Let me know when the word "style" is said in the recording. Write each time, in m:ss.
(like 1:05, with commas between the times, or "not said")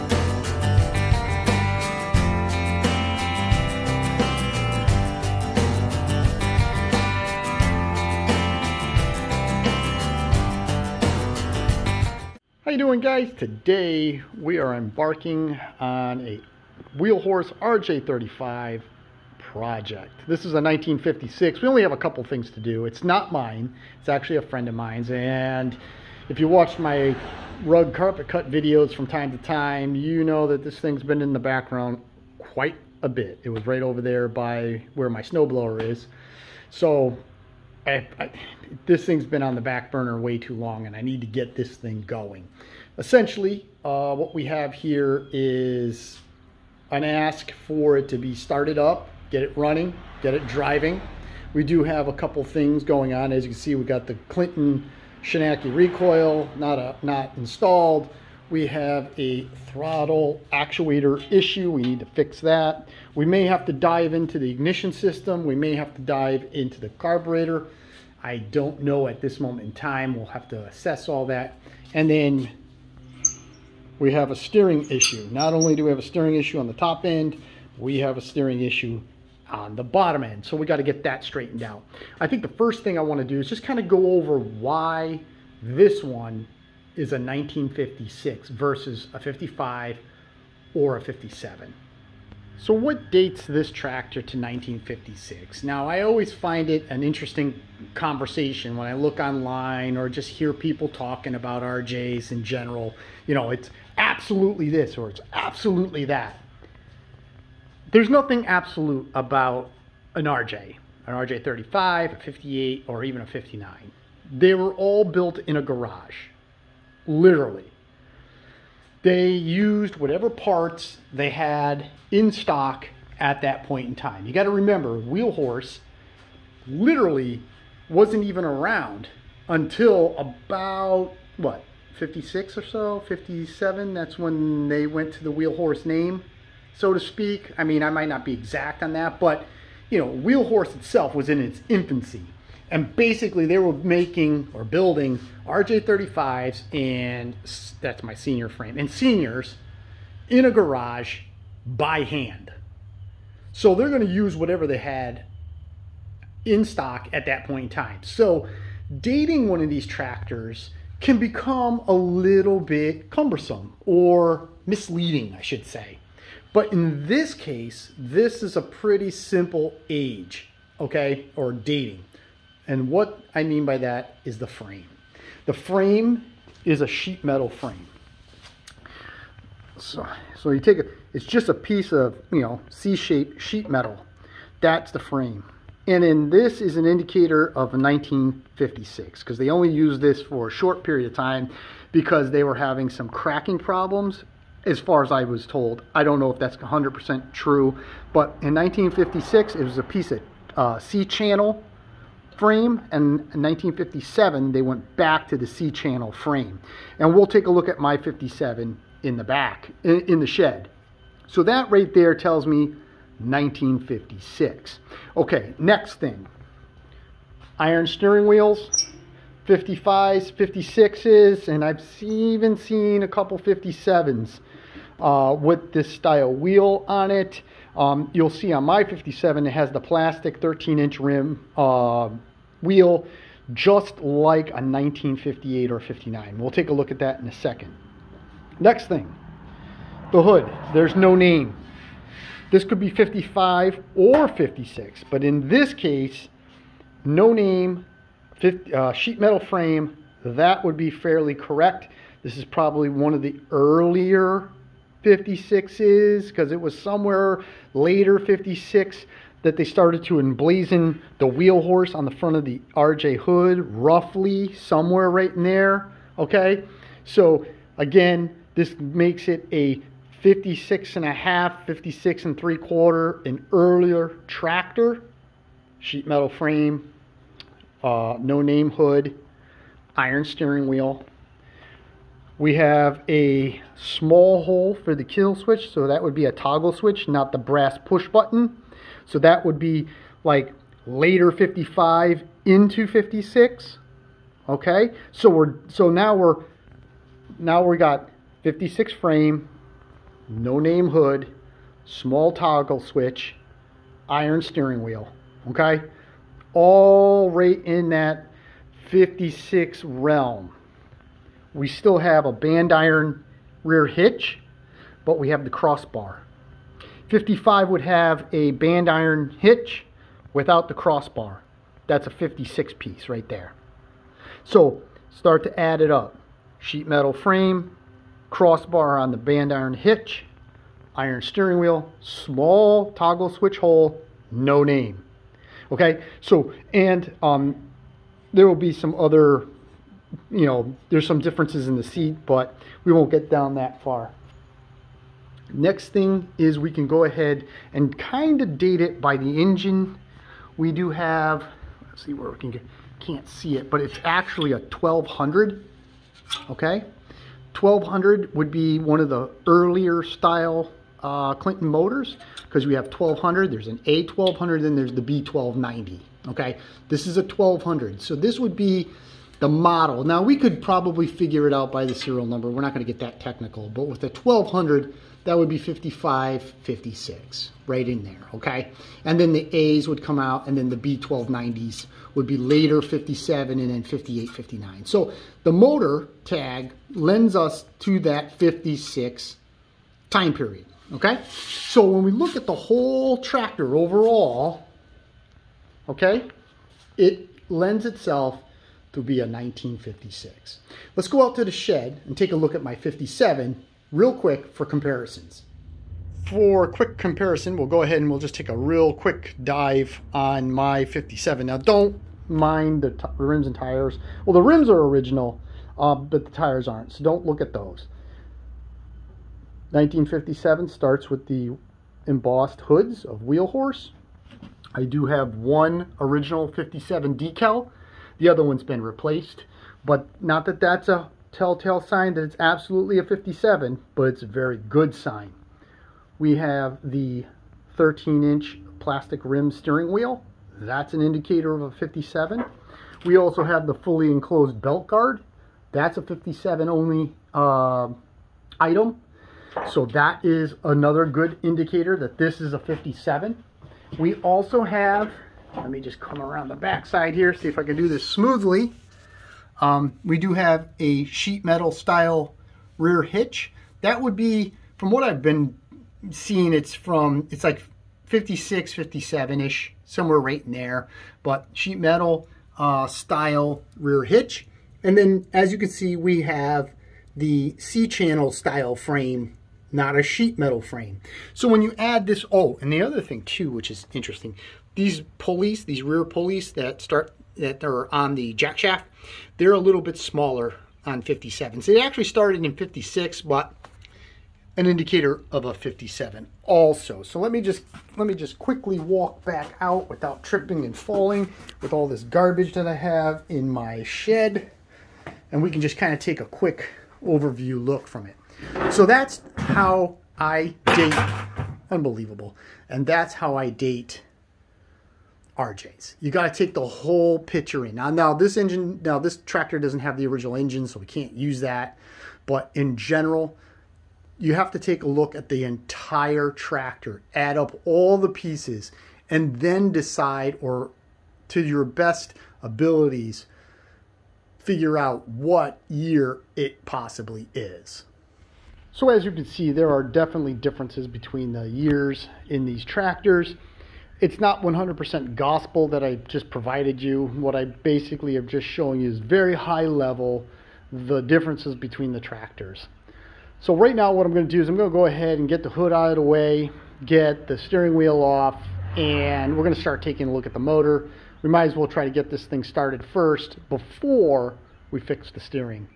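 3:45, 6:00, 7:41, 7:52, 7:58.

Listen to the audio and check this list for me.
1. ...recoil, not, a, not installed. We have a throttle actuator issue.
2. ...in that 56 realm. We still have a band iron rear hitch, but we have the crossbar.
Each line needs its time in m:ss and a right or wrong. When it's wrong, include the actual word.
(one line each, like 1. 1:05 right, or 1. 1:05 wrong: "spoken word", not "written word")
1. 0:55 right
2. 5:07 right.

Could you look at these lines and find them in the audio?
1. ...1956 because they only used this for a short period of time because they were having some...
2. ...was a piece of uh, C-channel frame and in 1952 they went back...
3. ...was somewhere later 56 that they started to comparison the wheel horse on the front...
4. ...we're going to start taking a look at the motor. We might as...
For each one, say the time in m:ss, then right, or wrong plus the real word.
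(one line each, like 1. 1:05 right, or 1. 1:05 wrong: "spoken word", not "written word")
1. 3:07 right
2. 3:19 wrong: "1957", not "1952"
3. 4:16 wrong: "emblazon", not "comparison"
4. 9:19 right.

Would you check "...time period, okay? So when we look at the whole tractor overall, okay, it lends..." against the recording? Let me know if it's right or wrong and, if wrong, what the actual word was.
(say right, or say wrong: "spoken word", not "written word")
right.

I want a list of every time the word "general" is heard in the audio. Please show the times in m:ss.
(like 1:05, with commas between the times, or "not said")
1:42, 8:42.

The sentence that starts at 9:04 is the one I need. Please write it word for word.
It's not 100% gospel that I just provided you.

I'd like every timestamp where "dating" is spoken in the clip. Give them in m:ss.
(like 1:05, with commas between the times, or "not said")
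2:39, 2:51.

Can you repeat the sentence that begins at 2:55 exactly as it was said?
The frame is a sheet metal frame.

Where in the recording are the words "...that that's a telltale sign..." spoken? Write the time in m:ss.
7:10.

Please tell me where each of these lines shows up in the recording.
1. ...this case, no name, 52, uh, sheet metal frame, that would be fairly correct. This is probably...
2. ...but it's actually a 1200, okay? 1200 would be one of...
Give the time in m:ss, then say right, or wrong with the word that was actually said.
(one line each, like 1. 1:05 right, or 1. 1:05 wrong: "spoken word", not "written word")
1. 4:05 wrong: "50", not "52"
2. 5:53 right.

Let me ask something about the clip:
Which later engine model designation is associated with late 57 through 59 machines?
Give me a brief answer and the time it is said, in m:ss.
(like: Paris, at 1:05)
B1290, at 6:05.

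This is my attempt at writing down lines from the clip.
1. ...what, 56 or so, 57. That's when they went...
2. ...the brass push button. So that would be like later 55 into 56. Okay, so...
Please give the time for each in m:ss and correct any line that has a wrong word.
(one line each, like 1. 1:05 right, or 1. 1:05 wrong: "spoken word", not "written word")
1. 2:11 right
2. 4:47 right.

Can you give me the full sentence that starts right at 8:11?
It actually started in 56, but an indicator of a 57 also.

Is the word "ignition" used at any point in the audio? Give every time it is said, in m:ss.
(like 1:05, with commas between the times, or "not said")
1:04.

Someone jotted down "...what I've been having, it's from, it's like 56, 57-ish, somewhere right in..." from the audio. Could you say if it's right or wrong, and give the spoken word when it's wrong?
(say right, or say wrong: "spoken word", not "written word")
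wrong: "seeing", not "having".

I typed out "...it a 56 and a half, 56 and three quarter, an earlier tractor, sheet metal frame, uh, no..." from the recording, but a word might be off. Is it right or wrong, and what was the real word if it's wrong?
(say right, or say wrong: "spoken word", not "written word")
right.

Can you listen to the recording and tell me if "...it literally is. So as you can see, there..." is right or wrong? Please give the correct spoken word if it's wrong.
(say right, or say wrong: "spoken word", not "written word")
wrong: "possibly", not "literally".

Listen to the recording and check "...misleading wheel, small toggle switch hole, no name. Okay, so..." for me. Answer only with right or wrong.
wrong.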